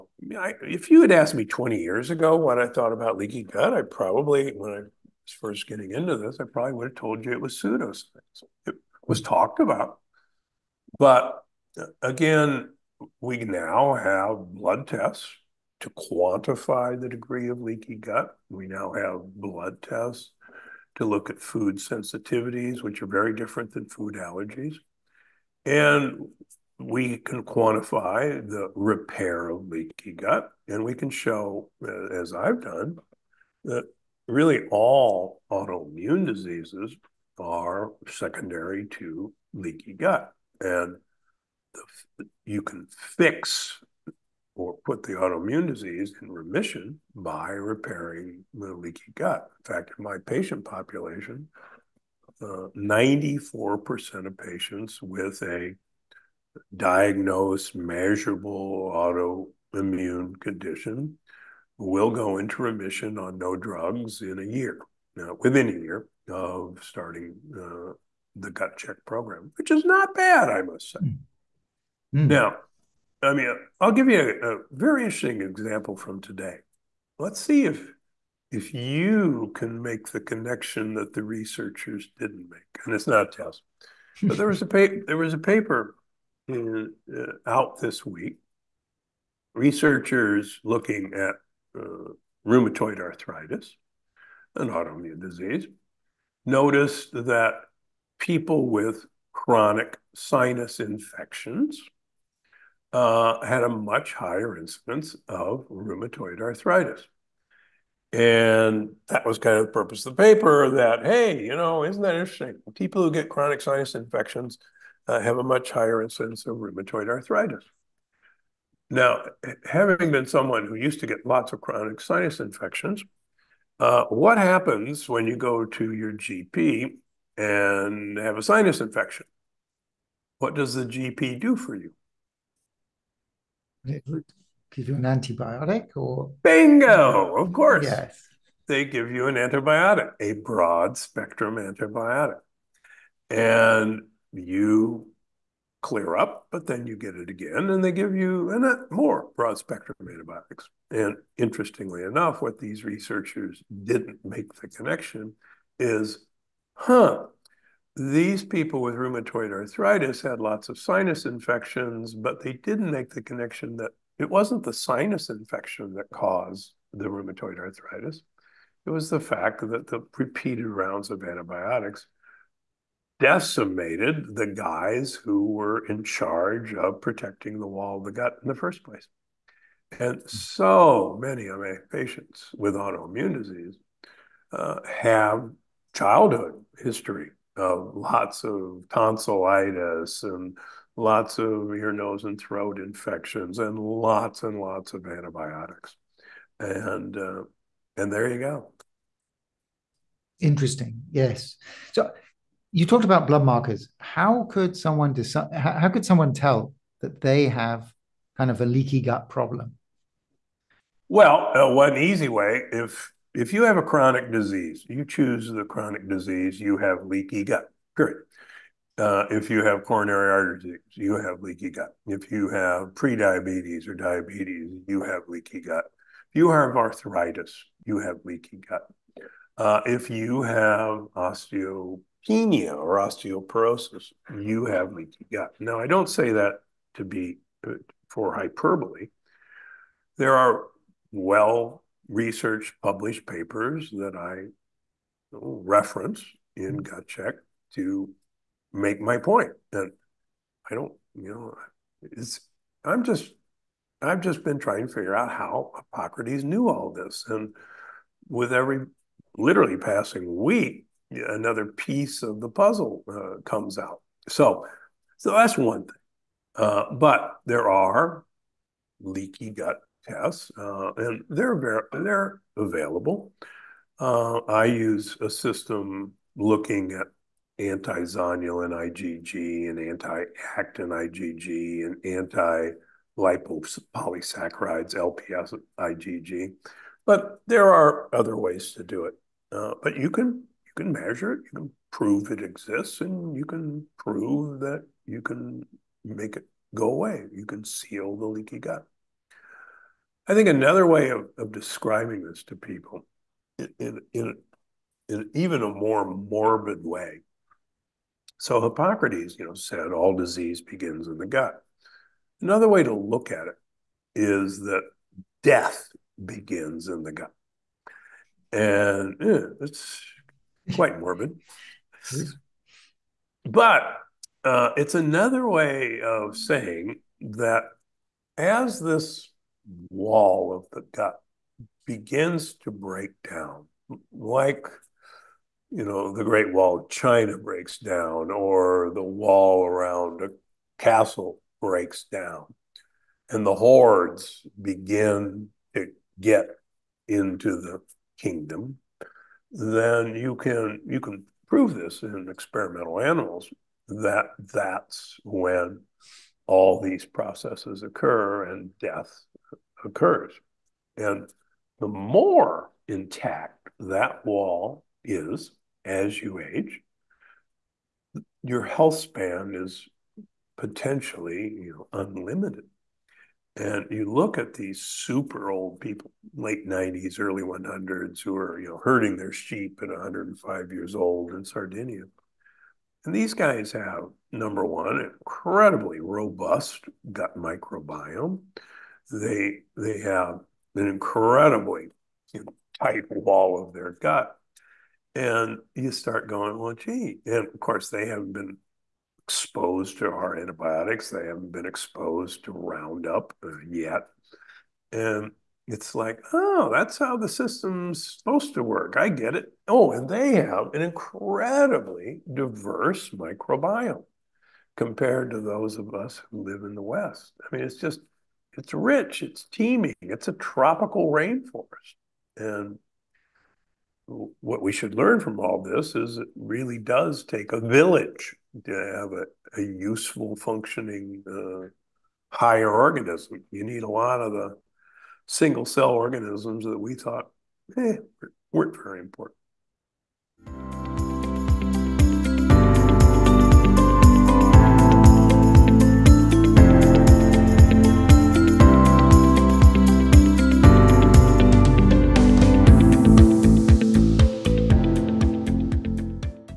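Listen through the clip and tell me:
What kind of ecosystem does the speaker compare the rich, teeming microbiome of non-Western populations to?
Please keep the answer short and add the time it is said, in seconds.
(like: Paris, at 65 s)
tropical rainforest, at 420 s.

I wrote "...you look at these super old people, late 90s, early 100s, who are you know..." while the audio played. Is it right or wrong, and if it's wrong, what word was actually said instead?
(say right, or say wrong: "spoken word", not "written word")
right.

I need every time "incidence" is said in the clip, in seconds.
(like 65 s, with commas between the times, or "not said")
104 s, 116 s.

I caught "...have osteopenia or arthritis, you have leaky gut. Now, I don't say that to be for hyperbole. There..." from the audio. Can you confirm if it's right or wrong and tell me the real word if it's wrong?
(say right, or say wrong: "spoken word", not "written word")
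wrong: "osteoporosis", not "arthritis".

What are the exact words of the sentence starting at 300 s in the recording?
I think another way of, of describing this to people in, in, in even a more morbid way.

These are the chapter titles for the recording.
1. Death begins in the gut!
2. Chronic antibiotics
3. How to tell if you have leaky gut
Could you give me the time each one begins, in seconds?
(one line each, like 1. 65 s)
1. 311 s
2. 71 s
3. 201 s.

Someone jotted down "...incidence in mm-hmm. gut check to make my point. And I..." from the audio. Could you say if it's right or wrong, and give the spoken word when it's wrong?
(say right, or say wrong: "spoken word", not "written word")
wrong: "reference", not "incidence".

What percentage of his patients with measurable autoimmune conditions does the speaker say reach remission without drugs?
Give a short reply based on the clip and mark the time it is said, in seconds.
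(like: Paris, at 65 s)
94%, at 52 s.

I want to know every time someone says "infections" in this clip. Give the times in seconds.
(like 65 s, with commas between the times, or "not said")
100 s, 113 s, 122 s, 128 s, 161 s, 165 s, 192 s.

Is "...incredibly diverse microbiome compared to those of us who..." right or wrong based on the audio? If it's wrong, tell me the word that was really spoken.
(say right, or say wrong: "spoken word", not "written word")
right.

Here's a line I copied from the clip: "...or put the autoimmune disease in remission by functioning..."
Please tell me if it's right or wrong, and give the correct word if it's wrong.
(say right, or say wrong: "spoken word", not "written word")
wrong: "repairing", not "functioning".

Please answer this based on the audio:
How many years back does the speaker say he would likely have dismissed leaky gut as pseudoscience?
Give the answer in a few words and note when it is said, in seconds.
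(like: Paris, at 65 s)
20 years, at 1 s.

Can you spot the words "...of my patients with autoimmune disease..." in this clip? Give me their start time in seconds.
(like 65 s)
181 s.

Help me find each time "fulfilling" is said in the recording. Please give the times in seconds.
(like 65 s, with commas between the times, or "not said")
not said.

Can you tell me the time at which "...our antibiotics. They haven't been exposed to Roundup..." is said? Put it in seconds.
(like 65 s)
400 s.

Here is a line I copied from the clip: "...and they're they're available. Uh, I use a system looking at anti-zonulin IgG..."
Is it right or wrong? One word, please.
right.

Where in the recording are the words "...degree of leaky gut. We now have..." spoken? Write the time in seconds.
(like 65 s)
17 s.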